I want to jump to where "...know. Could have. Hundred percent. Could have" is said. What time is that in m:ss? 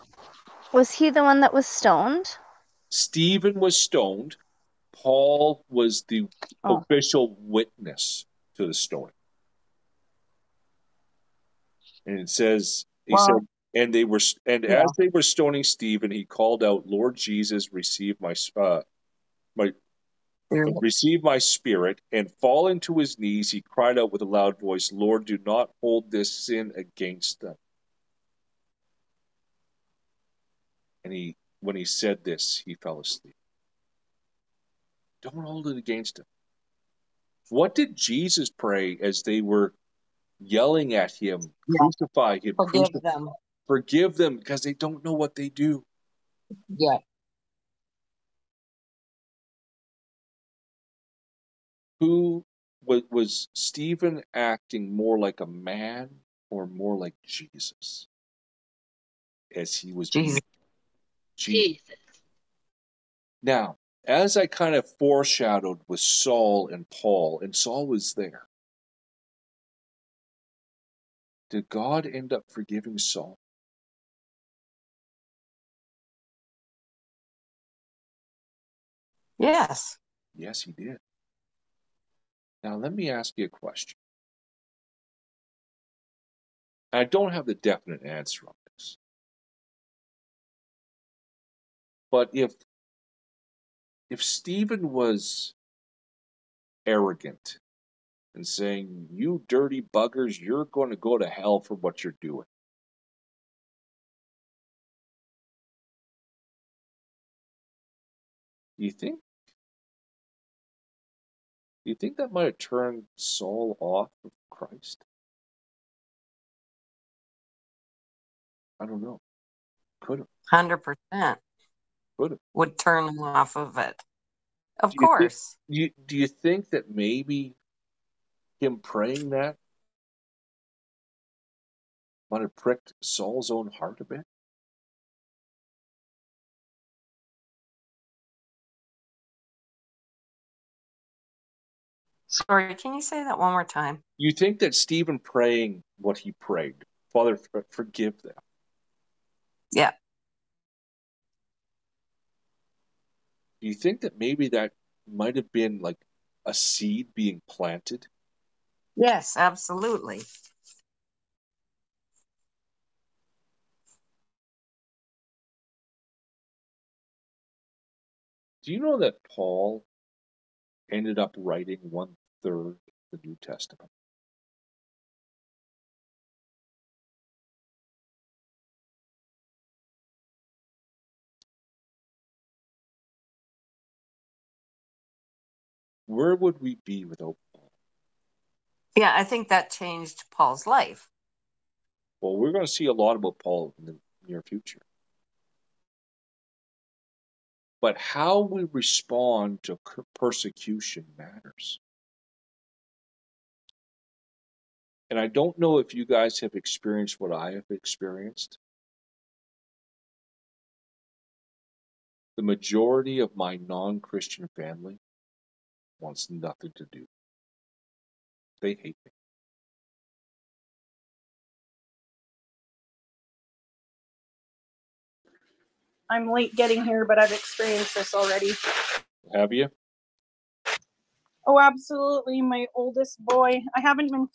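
1:59.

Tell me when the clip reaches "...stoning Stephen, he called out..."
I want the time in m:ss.
0:15.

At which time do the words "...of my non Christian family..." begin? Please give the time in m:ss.
3:33.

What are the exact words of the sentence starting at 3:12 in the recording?
Well, we're going to see a lot about Paul in the near future.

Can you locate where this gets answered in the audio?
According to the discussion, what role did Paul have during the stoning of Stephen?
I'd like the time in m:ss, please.
0:06.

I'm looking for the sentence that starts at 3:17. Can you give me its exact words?
But how we respond to persecution matters.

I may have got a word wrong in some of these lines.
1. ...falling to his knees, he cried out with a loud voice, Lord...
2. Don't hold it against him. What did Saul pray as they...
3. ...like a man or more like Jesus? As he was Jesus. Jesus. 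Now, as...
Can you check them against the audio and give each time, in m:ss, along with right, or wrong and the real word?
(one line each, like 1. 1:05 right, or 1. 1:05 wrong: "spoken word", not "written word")
1. 0:22 right
2. 0:35 wrong: "Jesus", not "Saul"
3. 0:55 right.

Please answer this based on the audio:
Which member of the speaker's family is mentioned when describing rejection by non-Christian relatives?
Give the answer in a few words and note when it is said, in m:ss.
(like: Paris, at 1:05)
Oldest boy, at 3:52.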